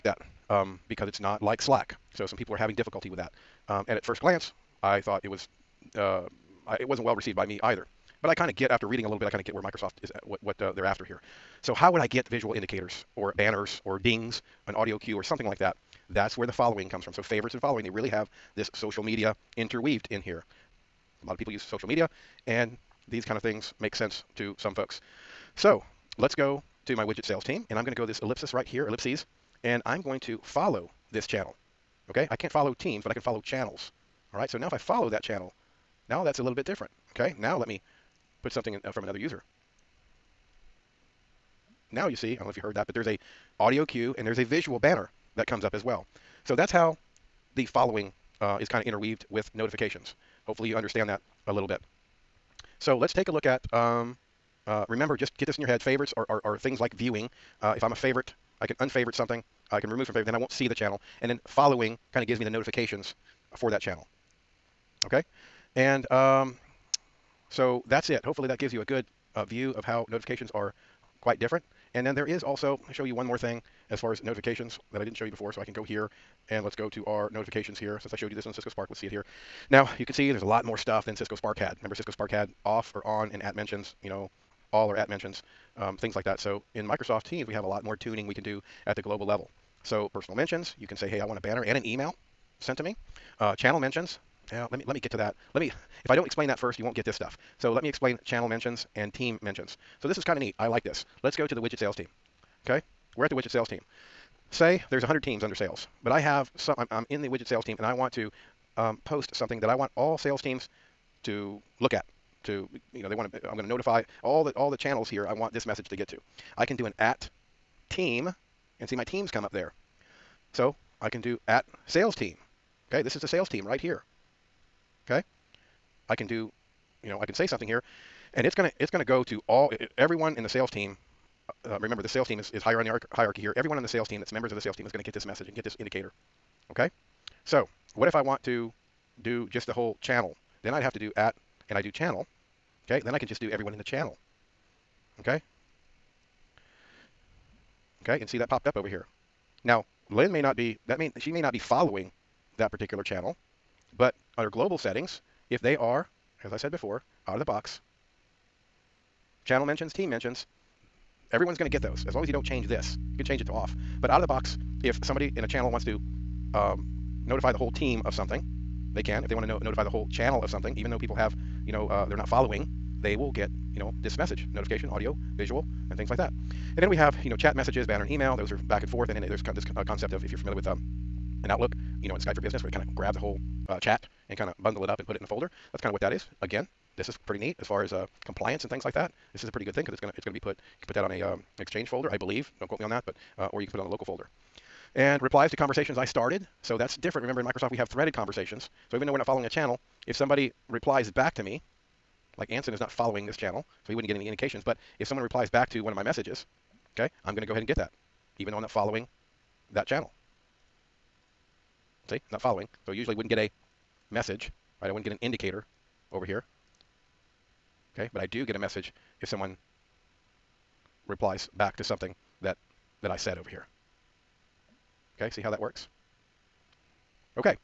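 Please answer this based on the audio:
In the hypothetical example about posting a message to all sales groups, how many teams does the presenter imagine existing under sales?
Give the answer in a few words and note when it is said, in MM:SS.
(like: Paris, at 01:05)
100, at 01:44.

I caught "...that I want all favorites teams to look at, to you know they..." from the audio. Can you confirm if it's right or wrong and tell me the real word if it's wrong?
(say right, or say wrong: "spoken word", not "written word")
wrong: "sales", not "favorites".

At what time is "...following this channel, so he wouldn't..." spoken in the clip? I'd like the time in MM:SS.
03:22.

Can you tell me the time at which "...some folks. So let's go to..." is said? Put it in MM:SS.
00:24.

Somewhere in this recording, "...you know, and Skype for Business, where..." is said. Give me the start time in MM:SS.
03:02.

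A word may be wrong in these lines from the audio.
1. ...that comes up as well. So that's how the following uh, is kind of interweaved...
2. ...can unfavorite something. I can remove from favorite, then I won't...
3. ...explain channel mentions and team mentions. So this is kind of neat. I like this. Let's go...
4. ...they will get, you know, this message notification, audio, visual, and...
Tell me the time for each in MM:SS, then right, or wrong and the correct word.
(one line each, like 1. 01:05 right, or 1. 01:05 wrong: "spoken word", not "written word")
1. 00:45 right
2. 00:58 right
3. 01:37 right
4. 02:53 right.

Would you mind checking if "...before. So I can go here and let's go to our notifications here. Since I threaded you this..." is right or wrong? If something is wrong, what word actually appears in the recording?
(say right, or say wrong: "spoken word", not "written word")
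wrong: "showed", not "threaded".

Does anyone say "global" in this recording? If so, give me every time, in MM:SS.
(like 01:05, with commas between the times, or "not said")
01:29, 02:34.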